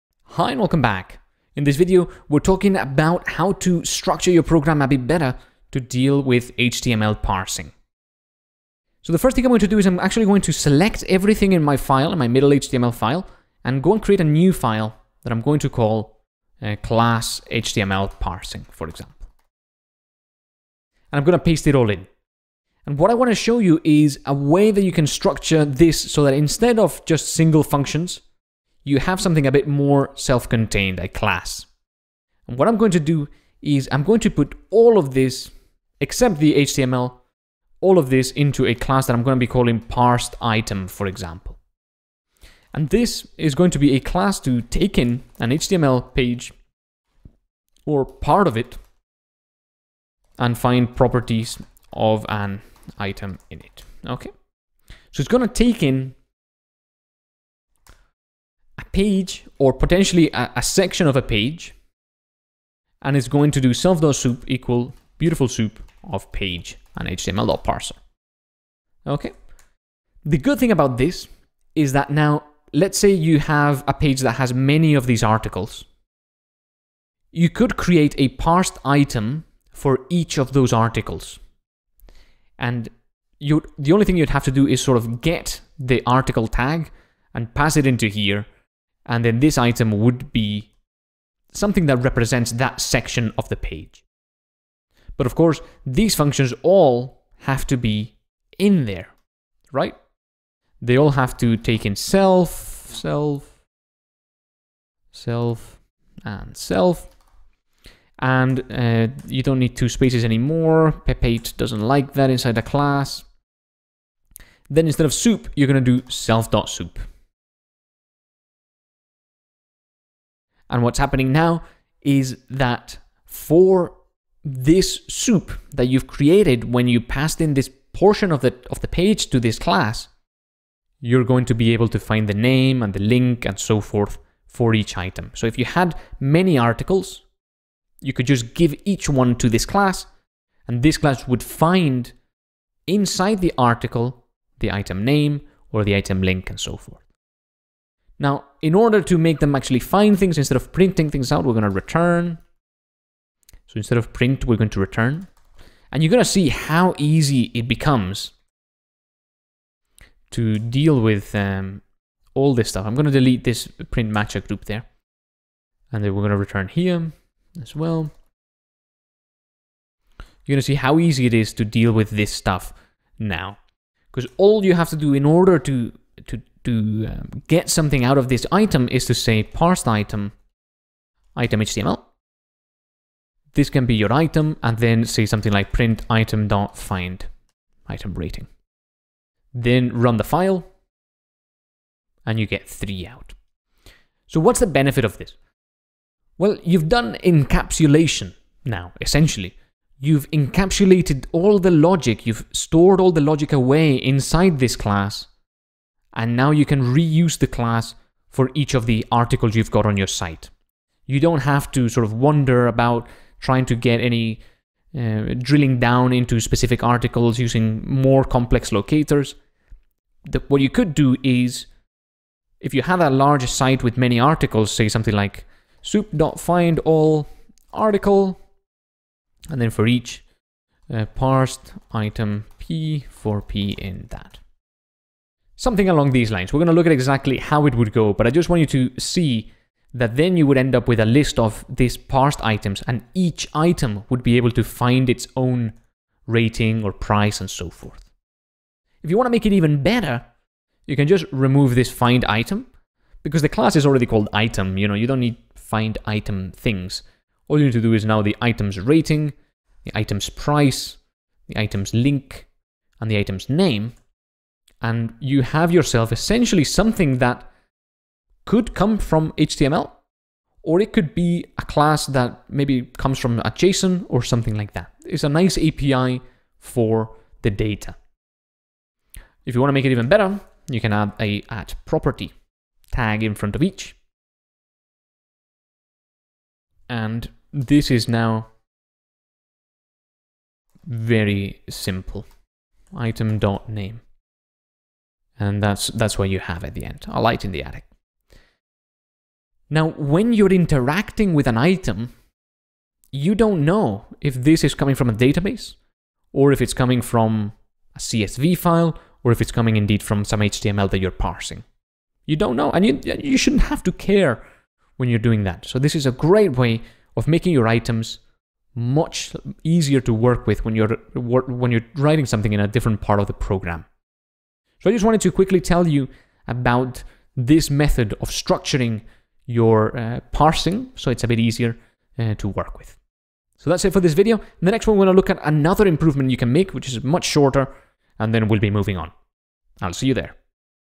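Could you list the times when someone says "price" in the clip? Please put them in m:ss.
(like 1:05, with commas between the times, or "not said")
4:06, 4:20.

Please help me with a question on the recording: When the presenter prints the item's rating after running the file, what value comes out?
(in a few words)
3.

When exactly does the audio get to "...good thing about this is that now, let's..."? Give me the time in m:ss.
1:10.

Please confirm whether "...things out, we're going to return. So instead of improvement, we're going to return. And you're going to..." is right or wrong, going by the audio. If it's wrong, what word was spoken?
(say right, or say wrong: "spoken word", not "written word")
wrong: "print", not "improvement".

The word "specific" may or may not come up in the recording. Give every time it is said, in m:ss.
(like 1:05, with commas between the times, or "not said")
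3:36.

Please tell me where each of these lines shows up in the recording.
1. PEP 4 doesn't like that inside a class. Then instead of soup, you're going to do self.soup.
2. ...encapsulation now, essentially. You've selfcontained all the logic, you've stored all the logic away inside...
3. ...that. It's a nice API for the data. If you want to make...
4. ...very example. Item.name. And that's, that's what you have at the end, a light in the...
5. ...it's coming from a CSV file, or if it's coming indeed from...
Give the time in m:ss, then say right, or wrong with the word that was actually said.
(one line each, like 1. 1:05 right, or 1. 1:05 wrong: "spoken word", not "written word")
1. 1:51 wrong: "8", not "4"
2. 3:17 wrong: "encapsulated", not "selfcontained"
3. 4:34 right
4. 4:50 wrong: "simple", not "example"
5. 5:06 right.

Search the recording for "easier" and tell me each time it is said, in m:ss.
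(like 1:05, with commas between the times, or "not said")
5:19, 5:31.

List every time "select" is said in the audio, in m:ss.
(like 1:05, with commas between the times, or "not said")
0:10.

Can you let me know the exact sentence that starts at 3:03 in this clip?
This can be your item, and then say something like print item dot find item rating.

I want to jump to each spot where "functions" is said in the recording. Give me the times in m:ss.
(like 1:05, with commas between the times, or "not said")
0:27, 1:36.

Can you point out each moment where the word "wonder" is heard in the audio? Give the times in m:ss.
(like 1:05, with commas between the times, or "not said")
3:32.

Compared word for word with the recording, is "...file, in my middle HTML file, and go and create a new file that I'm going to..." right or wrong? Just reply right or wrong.
right.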